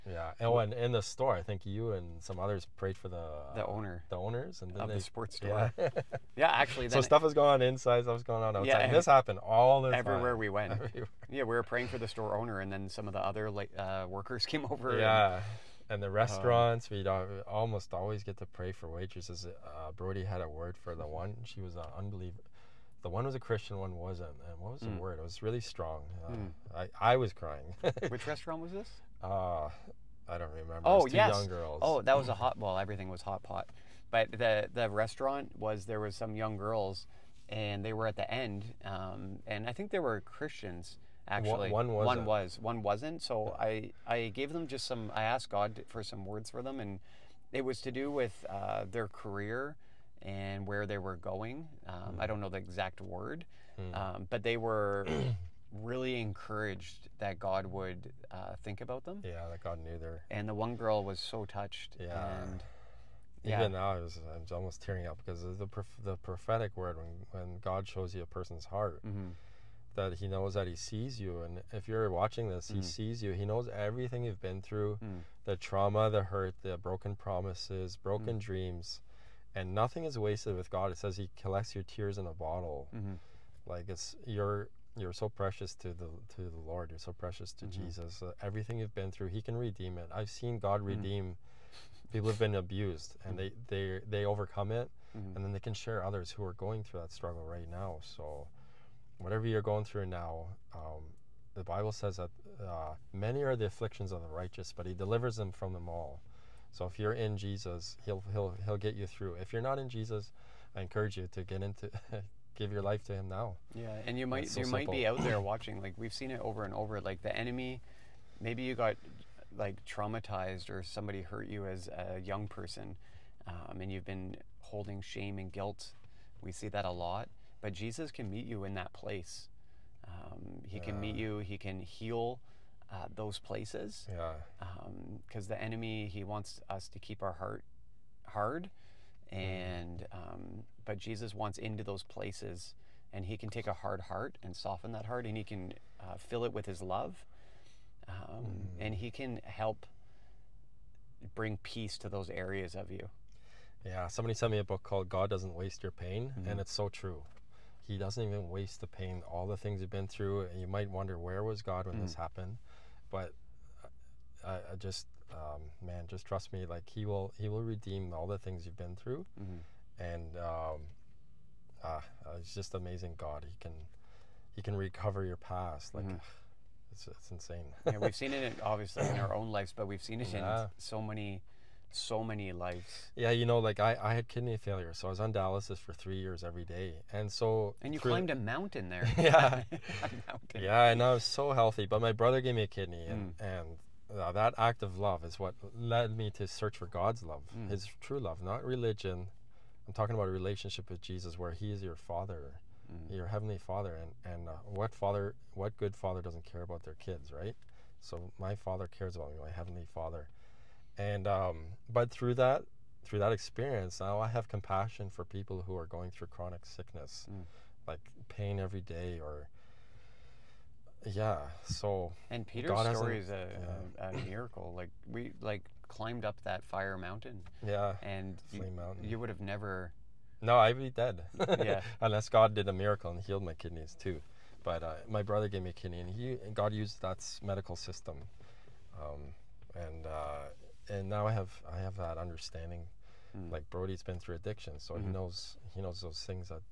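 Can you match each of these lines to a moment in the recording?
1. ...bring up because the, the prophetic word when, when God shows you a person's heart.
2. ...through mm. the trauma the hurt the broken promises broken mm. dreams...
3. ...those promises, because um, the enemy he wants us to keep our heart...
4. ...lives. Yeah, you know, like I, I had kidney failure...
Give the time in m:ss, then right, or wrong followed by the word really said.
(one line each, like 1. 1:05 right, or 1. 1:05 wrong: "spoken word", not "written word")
1. 1:04 wrong: "tearing", not "bring"
2. 1:14 right
3. 2:13 wrong: "places", not "promises"
4. 3:02 right.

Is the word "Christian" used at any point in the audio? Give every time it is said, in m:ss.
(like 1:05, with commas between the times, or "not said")
0:23, 0:40.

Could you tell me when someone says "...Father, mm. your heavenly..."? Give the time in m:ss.
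3:21.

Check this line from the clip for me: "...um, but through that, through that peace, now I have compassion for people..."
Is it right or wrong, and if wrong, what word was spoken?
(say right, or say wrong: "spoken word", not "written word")
wrong: "experience", not "peace".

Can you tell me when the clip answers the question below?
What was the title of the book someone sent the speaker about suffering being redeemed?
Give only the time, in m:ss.
2:35.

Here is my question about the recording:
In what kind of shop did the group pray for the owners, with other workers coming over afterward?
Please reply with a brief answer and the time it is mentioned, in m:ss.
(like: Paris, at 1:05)
Sports store, at 0:04.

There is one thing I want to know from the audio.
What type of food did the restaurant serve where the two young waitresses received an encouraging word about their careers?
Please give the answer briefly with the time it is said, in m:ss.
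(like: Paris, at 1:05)
Hot pot, at 0:33.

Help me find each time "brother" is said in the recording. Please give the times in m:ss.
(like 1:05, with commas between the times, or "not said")
3:12, 3:55.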